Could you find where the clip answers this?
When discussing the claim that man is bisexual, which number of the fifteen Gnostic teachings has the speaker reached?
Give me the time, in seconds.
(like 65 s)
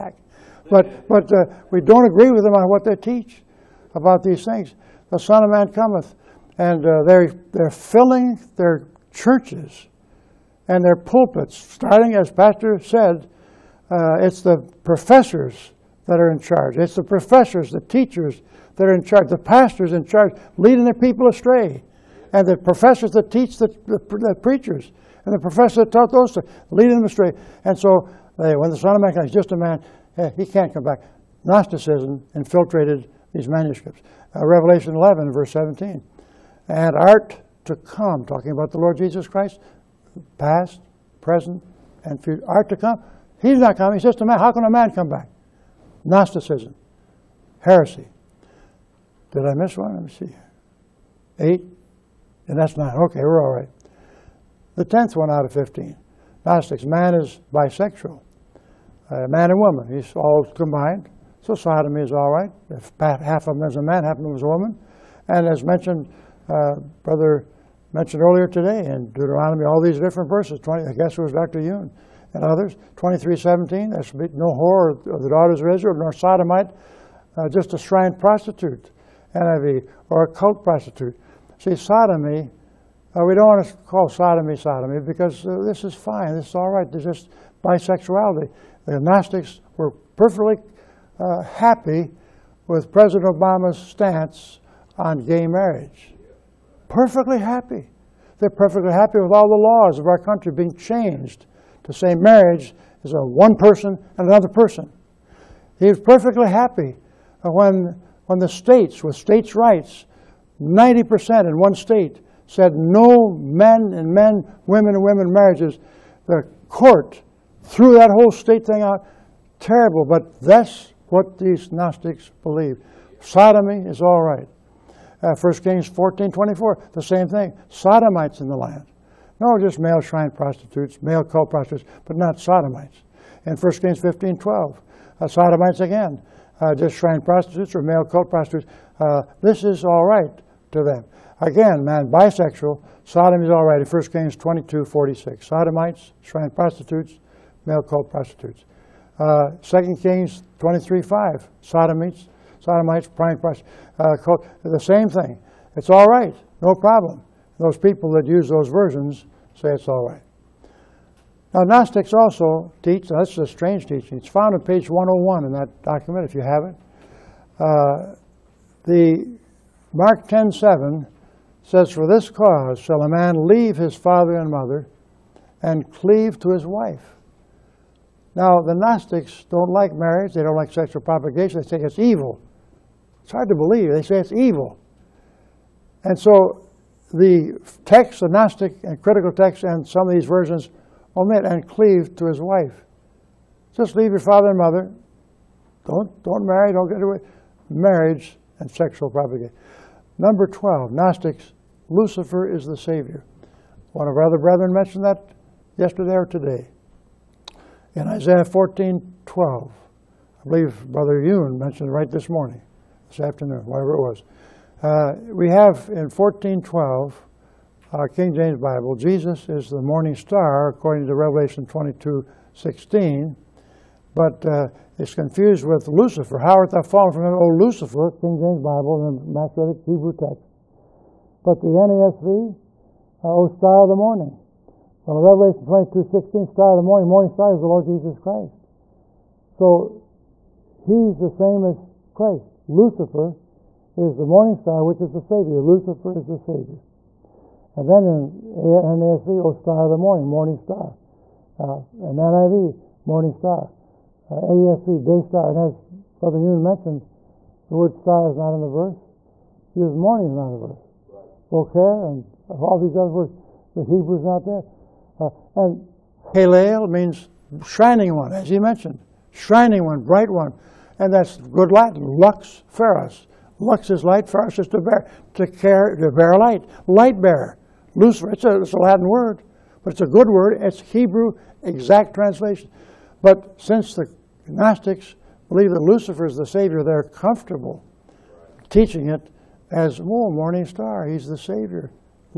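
54 s.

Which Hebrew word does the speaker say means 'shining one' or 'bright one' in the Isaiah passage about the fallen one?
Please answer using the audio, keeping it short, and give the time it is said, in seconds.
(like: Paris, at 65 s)
Halel, at 266 s.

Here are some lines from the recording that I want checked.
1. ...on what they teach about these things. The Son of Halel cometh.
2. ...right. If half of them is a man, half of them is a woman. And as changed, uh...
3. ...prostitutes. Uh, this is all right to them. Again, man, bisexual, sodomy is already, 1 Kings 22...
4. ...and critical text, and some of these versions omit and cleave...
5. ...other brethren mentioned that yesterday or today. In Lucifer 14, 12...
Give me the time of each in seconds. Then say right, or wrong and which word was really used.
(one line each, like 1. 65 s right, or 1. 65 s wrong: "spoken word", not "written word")
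1. 2 s wrong: "Man", not "Halel"
2. 62 s wrong: "mentioned", not "changed"
3. 138 s right
4. 188 s right
5. 204 s wrong: "Isaiah", not "Lucifer".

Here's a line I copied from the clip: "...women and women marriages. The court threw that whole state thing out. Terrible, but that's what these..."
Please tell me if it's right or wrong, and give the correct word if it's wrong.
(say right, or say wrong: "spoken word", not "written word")
right.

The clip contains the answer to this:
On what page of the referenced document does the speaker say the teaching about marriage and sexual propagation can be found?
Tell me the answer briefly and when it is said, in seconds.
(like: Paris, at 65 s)
101, at 164 s.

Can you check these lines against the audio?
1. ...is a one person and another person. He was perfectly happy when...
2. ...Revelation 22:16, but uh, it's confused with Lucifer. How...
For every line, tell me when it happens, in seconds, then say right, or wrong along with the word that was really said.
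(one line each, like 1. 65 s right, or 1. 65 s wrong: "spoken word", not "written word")
1. 103 s right
2. 221 s right.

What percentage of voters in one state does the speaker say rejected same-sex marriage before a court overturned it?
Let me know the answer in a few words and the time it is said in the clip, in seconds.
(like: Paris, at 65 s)
90%, at 110 s.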